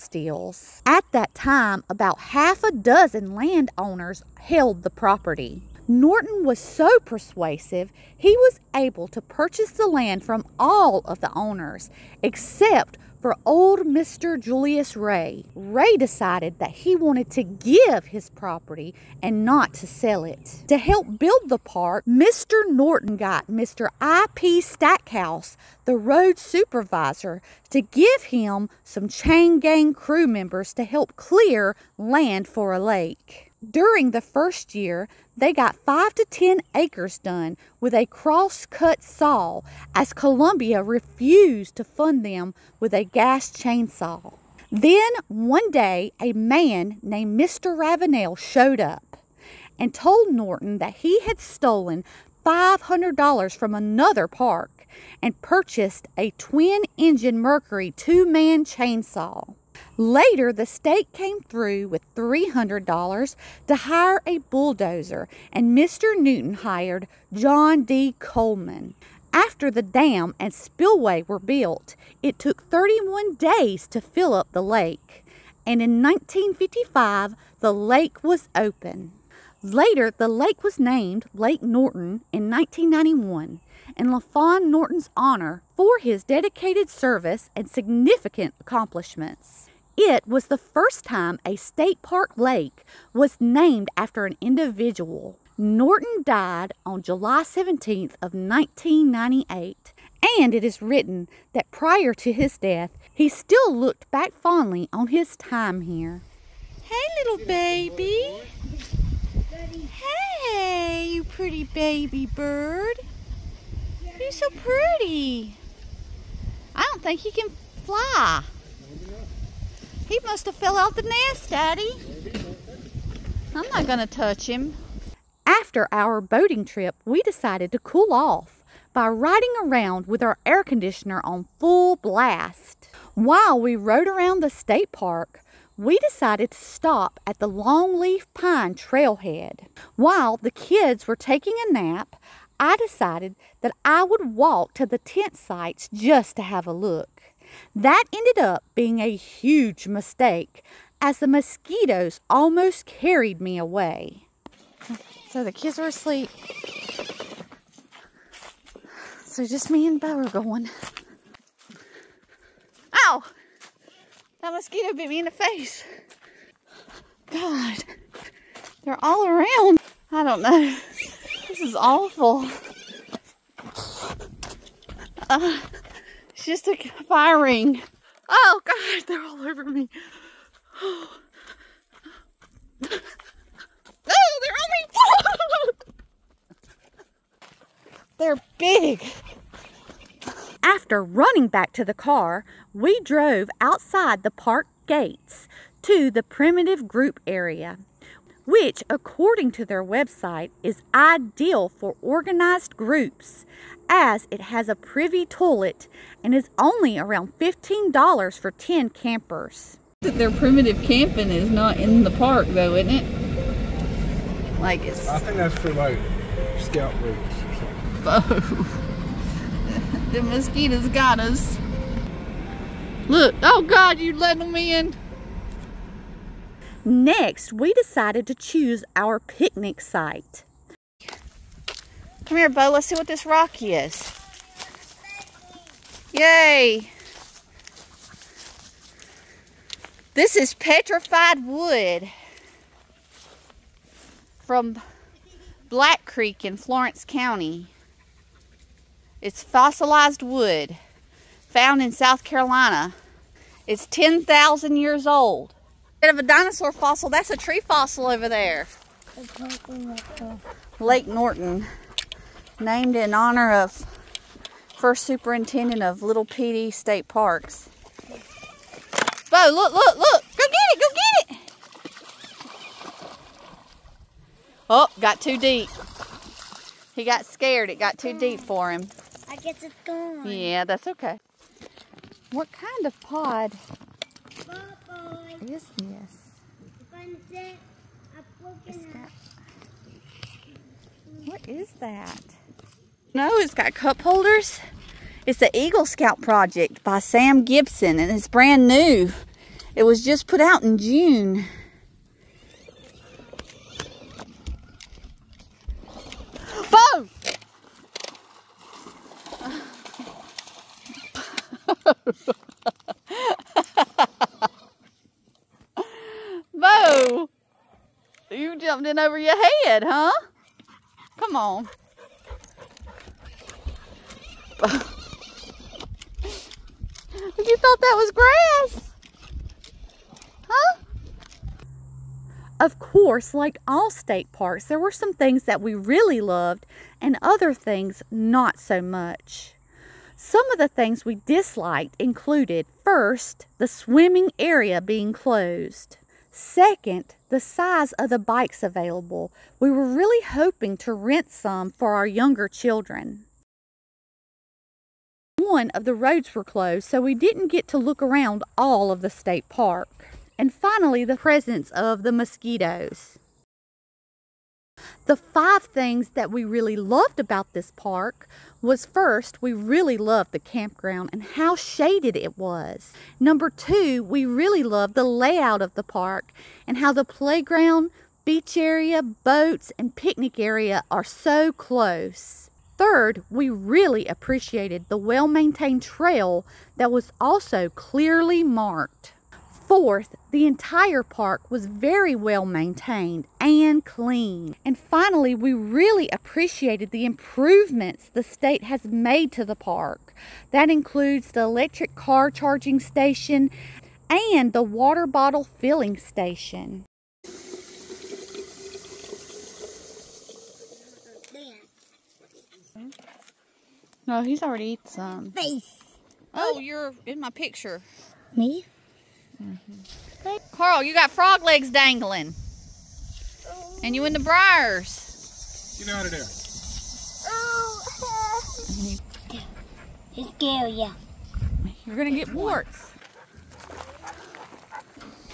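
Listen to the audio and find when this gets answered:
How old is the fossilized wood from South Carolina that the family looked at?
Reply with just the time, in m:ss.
4:13.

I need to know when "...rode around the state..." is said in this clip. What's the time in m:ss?
2:13.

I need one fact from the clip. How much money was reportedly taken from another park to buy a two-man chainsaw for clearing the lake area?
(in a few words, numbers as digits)
$500.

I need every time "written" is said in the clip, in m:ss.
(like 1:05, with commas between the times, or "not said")
1:40.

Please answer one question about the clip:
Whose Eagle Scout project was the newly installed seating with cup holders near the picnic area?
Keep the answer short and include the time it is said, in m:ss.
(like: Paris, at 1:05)
Sam Gibson, at 4:56.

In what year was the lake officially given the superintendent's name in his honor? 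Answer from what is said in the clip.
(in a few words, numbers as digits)
1991.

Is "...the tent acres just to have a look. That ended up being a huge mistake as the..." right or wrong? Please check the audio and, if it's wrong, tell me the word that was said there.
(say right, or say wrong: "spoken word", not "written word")
wrong: "sites", not "acres".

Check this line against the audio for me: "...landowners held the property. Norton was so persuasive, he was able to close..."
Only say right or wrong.
wrong.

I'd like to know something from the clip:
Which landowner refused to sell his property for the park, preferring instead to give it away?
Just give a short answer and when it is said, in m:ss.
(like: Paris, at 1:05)
Julius Ray, at 0:14.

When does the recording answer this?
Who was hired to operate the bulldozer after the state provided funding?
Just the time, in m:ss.
1:07.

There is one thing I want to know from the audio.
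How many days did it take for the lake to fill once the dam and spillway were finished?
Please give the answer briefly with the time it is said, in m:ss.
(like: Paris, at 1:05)
31, at 1:12.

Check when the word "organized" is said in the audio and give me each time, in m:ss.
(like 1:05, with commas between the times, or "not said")
3:22.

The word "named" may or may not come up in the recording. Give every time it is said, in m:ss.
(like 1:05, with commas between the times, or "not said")
0:47, 1:20, 1:33, 4:22.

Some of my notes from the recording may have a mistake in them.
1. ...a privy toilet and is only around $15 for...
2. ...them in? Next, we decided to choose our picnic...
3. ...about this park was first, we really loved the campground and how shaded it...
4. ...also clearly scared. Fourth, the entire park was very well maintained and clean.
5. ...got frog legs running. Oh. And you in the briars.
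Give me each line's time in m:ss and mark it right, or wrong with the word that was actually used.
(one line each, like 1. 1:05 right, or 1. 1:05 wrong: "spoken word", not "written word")
1. 3:24 right
2. 3:44 right
3. 6:07 right
4. 6:27 wrong: "marked", not "scared"
5. 7:00 wrong: "dangling", not "running".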